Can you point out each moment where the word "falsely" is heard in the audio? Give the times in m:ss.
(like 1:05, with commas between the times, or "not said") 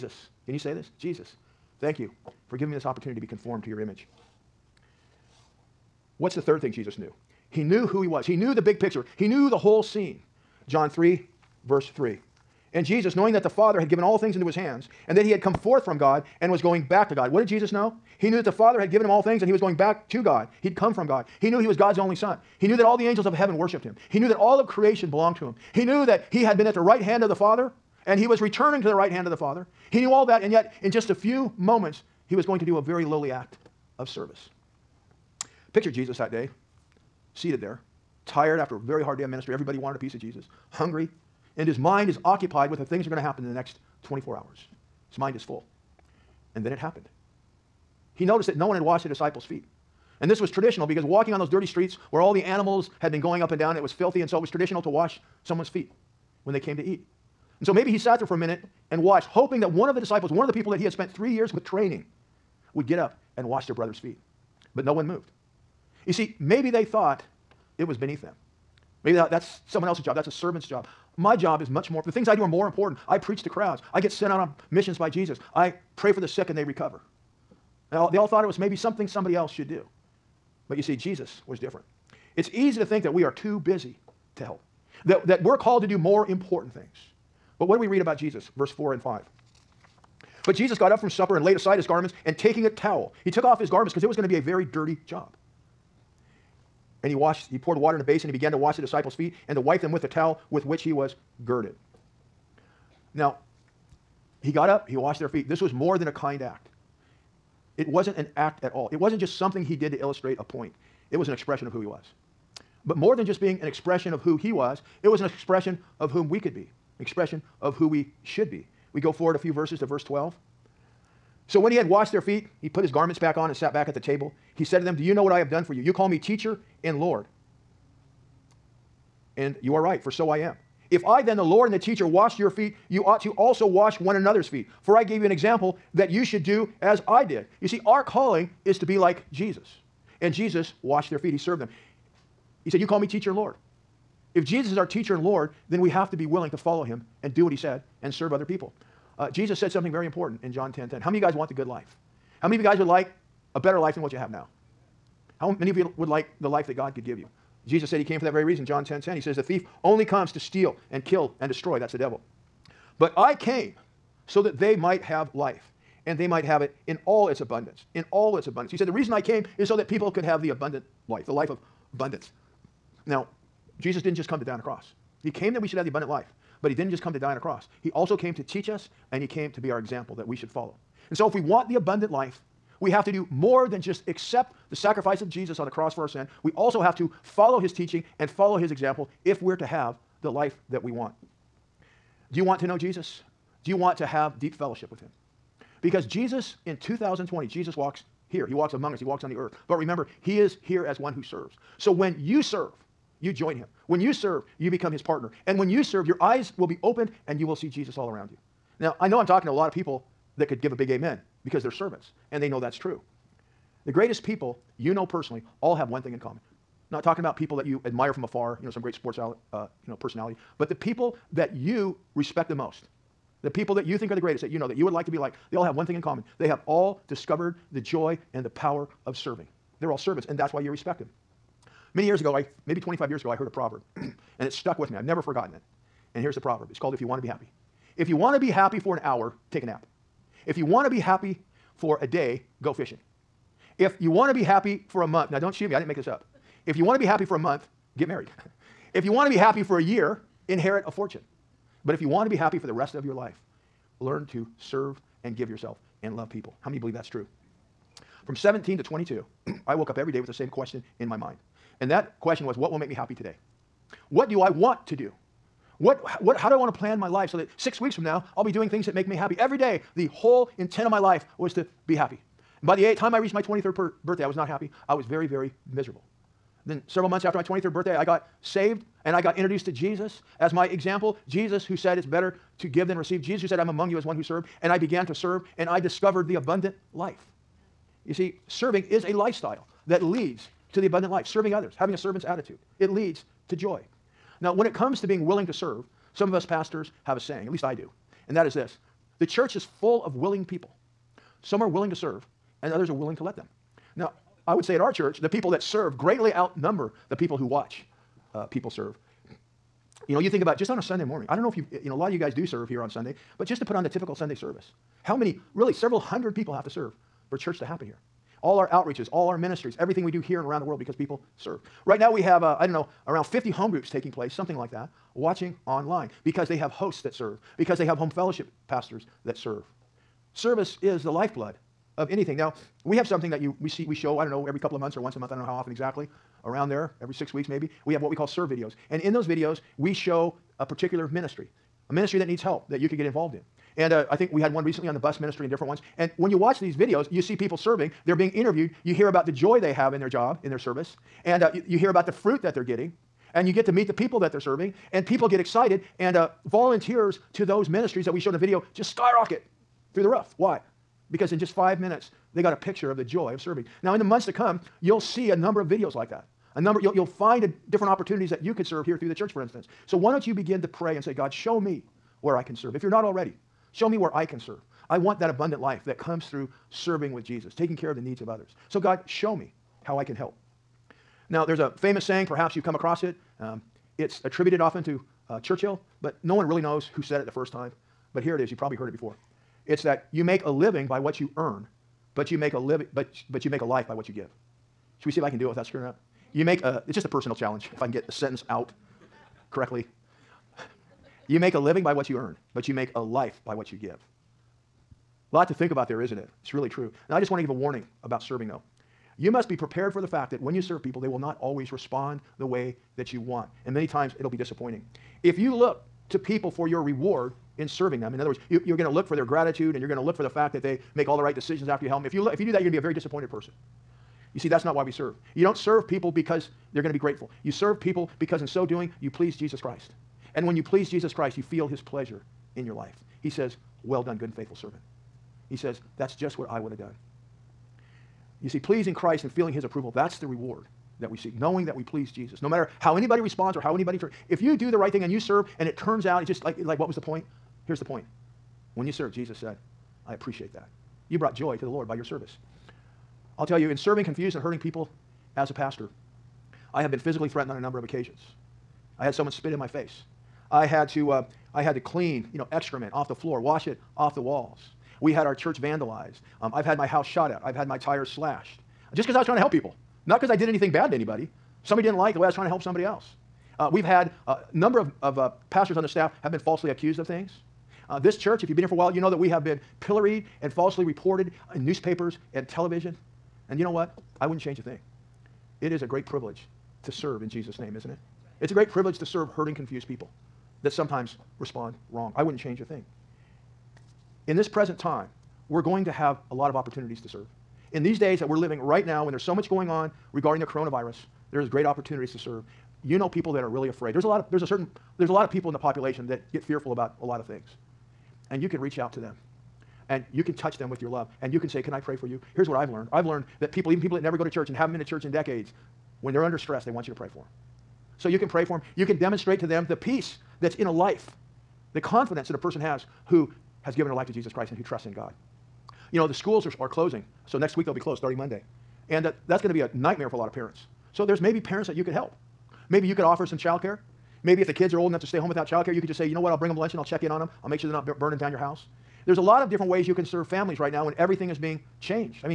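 7:56, 8:00.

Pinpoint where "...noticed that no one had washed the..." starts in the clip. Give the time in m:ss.
0:48.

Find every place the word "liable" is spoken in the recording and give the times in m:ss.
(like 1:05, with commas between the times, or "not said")
not said.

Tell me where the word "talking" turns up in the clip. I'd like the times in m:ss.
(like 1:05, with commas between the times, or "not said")
3:29, 3:37.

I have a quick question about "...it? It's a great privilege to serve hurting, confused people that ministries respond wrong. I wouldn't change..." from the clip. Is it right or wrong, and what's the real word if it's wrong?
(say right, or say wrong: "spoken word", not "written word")
wrong: "sometimes", not "ministries".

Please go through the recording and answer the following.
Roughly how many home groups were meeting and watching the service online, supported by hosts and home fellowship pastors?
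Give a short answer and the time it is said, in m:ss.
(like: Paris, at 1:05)
50, at 5:23.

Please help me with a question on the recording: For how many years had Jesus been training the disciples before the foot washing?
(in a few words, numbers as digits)
3.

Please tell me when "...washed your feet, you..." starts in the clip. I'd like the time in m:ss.
2:12.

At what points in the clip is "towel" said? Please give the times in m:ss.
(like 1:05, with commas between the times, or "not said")
1:32, 1:40.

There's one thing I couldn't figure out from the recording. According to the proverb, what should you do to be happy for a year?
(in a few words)
Inherit a fortune.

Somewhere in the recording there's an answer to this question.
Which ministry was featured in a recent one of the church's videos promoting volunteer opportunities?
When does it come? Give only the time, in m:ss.
5:44.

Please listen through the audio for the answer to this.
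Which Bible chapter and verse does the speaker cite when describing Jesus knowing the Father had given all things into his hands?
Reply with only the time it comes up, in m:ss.
0:10.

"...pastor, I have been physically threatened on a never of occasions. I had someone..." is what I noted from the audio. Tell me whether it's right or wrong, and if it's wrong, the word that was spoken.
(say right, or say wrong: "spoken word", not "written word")
wrong: "number", not "never".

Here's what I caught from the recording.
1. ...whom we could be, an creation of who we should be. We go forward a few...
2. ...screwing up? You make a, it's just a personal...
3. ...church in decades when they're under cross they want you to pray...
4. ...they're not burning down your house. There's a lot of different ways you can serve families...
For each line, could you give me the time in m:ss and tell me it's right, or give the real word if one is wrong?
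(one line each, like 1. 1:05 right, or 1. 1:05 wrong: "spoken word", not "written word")
1. 1:56 wrong: "expression", not "creation"
2. 6:35 right
3. 8:34 wrong: "stress", not "cross"
4. 8:57 right.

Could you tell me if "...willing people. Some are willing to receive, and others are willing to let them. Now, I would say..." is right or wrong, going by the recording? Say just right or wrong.
wrong.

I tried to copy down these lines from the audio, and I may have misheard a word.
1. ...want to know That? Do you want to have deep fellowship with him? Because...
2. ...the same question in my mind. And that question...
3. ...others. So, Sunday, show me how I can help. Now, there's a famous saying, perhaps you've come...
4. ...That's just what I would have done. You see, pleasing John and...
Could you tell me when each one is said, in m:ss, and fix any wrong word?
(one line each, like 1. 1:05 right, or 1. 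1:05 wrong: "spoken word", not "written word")
1. 3:12 wrong: "Jesus", not "That"
2. 4:20 right
3. 6:18 wrong: "God", not "Sunday"
4. 7:15 wrong: "Christ", not "John".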